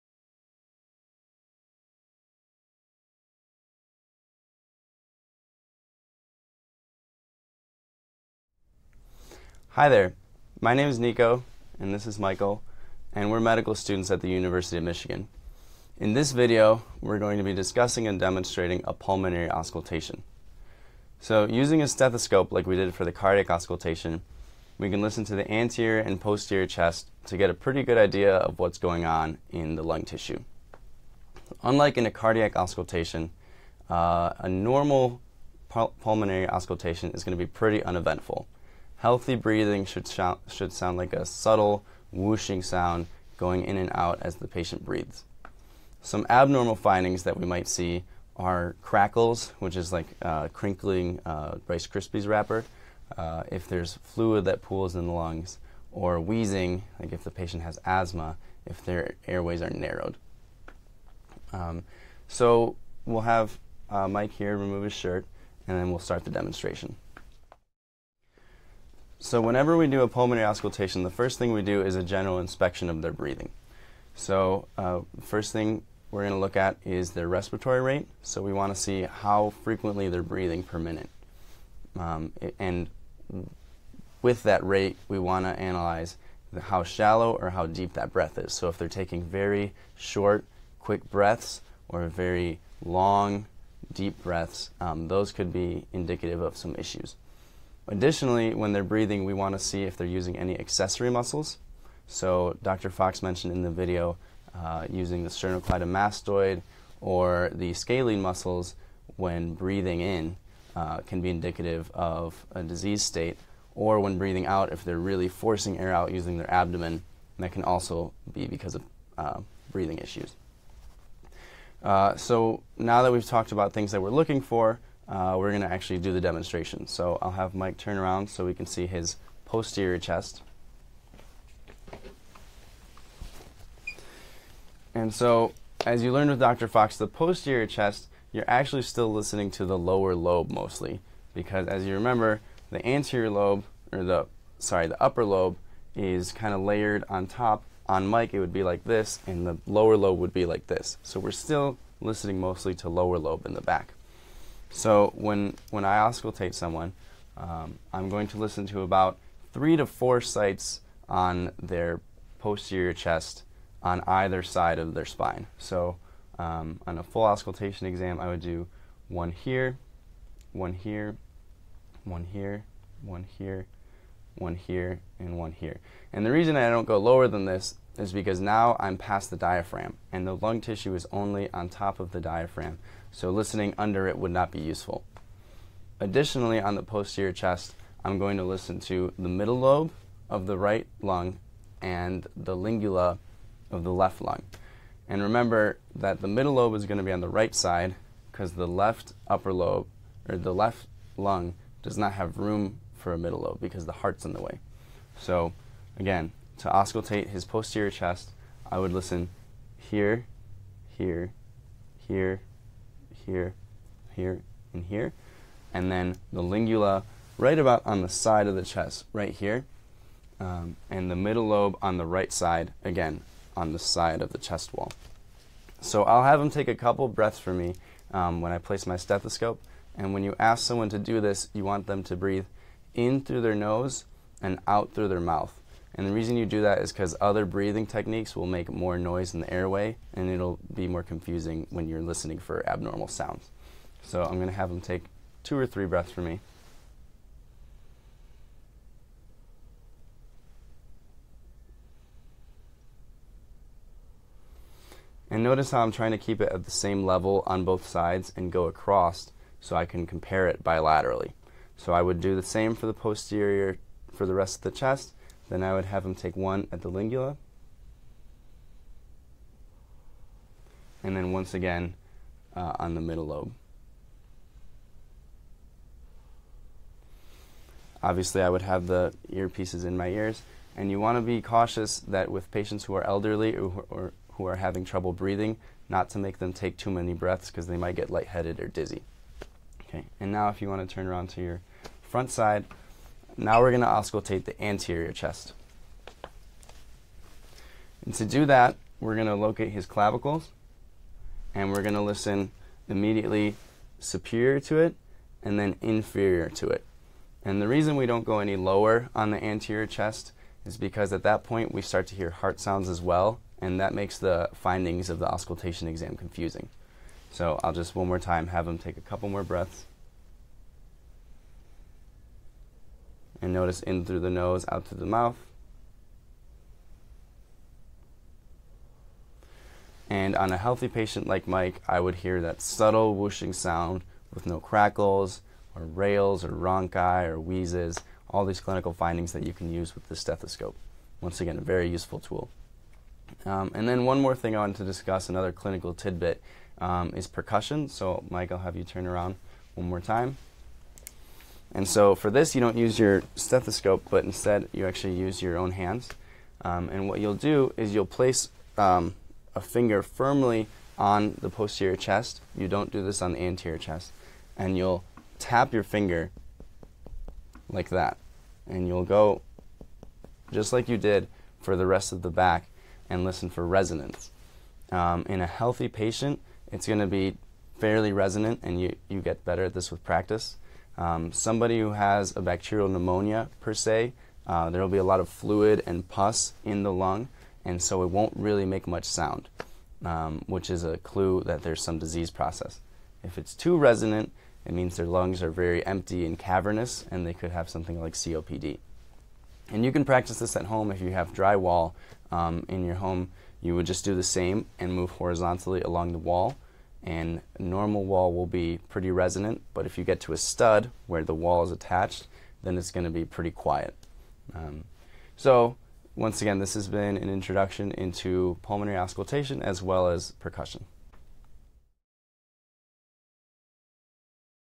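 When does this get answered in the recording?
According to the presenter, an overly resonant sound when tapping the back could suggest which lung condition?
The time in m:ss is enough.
6:38.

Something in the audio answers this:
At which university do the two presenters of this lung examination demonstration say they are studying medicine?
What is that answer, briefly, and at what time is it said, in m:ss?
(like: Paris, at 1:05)
University of Michigan, at 0:14.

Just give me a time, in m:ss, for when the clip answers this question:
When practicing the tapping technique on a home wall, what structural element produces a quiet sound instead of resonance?
6:50.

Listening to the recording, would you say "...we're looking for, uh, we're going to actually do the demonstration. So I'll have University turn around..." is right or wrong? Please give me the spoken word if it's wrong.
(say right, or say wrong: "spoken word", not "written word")
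wrong: "Mike", not "University".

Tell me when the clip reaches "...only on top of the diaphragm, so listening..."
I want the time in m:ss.
3:01.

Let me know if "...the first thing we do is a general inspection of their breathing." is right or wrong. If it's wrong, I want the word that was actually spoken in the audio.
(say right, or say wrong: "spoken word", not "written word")
right.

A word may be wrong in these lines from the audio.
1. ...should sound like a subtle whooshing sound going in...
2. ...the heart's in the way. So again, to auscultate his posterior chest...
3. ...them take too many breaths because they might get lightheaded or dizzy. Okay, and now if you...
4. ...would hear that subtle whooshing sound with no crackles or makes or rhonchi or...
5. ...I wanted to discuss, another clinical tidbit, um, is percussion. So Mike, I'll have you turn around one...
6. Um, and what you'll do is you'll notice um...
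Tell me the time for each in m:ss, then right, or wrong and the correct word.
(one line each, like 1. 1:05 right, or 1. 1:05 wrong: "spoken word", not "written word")
1. 0:40 right
2. 3:23 right
3. 4:46 right
4. 5:32 wrong: "rales", not "makes"
5. 5:44 right
6. 5:56 wrong: "place", not "notice".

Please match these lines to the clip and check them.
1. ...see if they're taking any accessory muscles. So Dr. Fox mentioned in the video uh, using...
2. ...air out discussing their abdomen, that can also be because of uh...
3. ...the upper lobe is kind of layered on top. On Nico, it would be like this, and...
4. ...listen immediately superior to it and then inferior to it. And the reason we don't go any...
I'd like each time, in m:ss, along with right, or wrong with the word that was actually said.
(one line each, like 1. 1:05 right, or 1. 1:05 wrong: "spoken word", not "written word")
1. 1:39 wrong: "using", not "taking"
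2. 1:55 wrong: "using", not "discussing"
3. 2:24 wrong: "Mike", not "Nico"
4. 5:02 right.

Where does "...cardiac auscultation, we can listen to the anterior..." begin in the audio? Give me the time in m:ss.
0:23.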